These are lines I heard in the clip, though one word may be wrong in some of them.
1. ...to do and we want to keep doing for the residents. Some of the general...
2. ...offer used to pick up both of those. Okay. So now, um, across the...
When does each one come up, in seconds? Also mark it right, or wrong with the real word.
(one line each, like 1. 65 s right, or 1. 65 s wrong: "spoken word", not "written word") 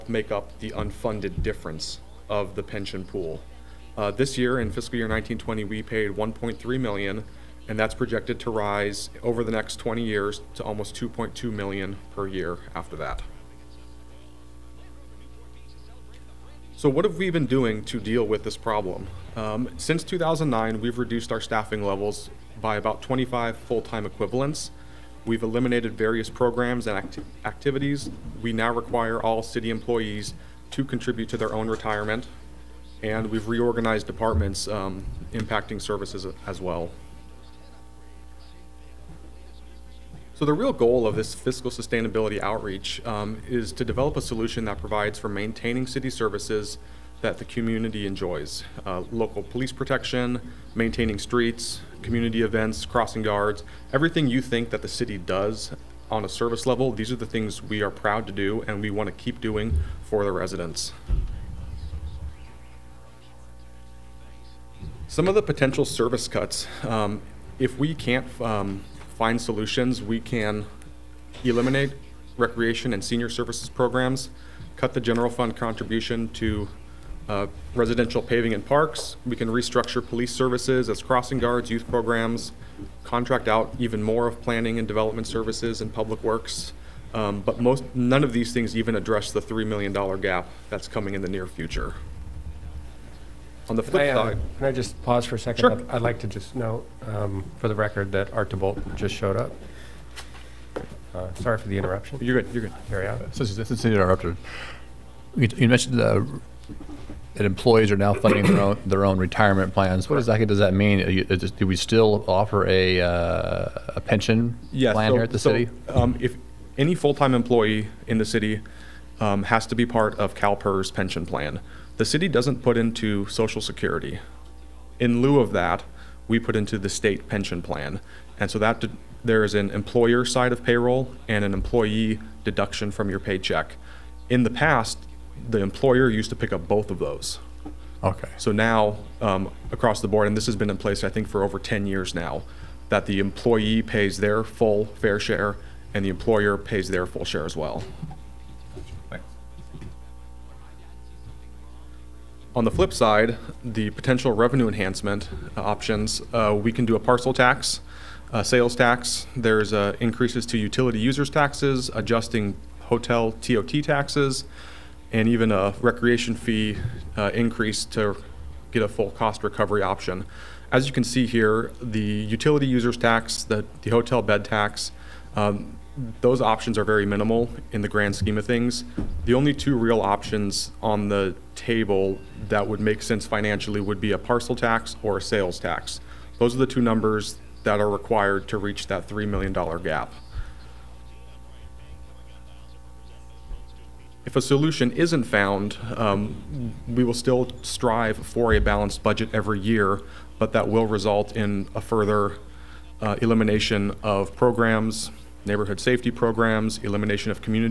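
1. 58 s wrong: "potential", not "general"
2. 135 s wrong: "employer", not "offer".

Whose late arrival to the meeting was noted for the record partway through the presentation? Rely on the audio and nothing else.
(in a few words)
Art DeBolt.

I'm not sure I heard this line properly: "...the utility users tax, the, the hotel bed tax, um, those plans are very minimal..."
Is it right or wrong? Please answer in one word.
wrong.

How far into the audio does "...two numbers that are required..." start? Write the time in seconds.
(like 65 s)
186 s.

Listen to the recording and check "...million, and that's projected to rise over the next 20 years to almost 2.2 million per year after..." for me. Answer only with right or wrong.
right.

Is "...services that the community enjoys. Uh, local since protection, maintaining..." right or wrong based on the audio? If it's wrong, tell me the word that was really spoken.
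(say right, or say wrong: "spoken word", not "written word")
wrong: "police", not "since".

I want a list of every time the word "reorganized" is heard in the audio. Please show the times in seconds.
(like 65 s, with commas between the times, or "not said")
33 s.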